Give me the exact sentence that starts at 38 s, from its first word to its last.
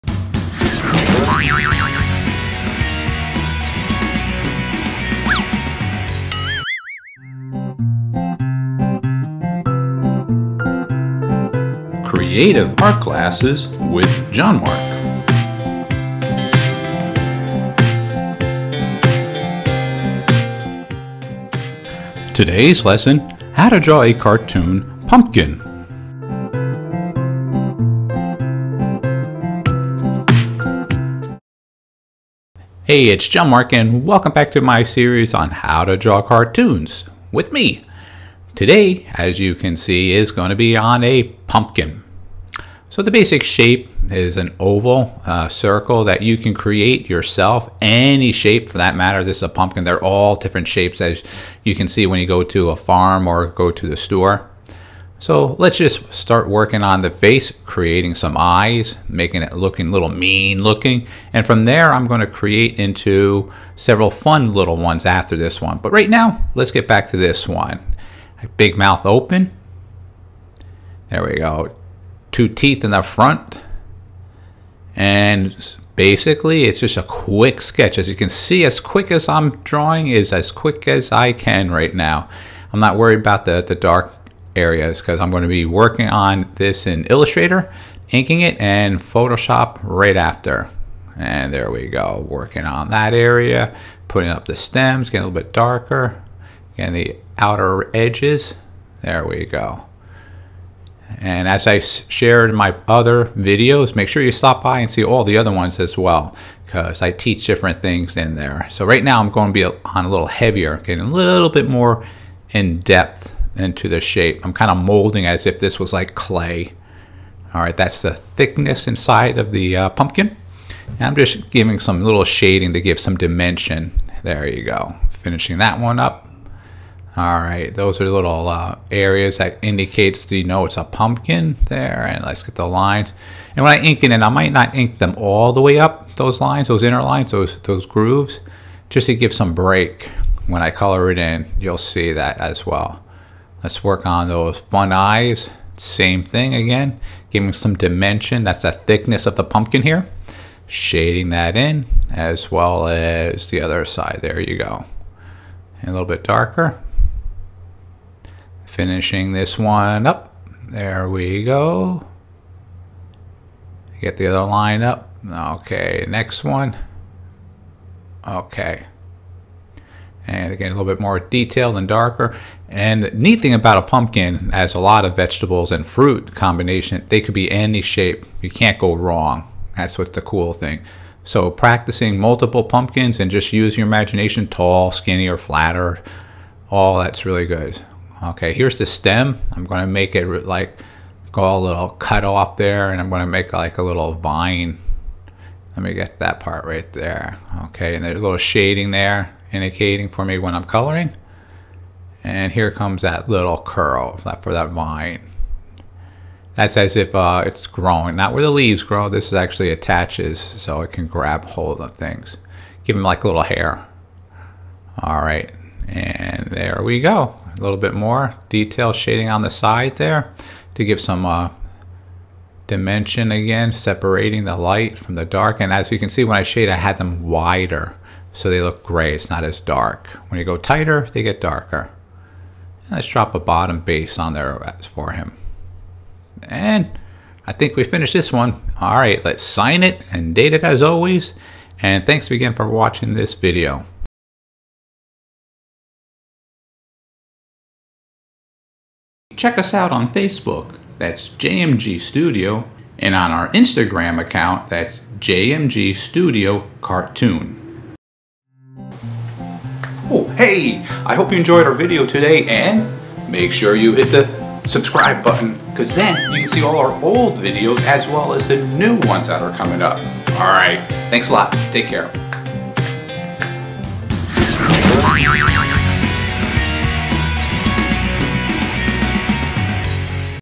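Today, as you can see, is going to be on a pumpkin.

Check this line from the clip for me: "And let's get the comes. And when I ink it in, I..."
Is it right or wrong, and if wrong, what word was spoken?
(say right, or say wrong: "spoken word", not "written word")
wrong: "lines", not "comes".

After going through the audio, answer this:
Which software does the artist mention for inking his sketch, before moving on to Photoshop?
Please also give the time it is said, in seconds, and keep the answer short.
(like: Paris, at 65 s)
Illustrator, at 87 s.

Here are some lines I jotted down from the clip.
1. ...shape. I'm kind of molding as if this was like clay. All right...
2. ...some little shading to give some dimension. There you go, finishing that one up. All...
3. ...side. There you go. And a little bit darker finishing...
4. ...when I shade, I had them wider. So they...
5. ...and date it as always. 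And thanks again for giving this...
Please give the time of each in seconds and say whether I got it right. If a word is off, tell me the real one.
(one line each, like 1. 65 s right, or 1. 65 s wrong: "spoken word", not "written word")
1. 113 s right
2. 121 s right
3. 153 s right
4. 226 s right
5. 240 s wrong: "watching", not "giving".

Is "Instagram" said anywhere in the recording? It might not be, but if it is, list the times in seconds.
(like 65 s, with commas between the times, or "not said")
253 s.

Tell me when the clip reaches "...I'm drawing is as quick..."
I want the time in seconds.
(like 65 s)
79 s.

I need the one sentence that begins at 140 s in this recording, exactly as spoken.
When I color it in, you'll see that as well.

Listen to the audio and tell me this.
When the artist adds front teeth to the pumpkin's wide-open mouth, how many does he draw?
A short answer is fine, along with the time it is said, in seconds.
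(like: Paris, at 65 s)
2, at 72 s.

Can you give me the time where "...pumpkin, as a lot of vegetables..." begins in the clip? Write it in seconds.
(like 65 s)
173 s.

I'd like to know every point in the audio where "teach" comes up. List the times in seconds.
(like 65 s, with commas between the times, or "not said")
107 s.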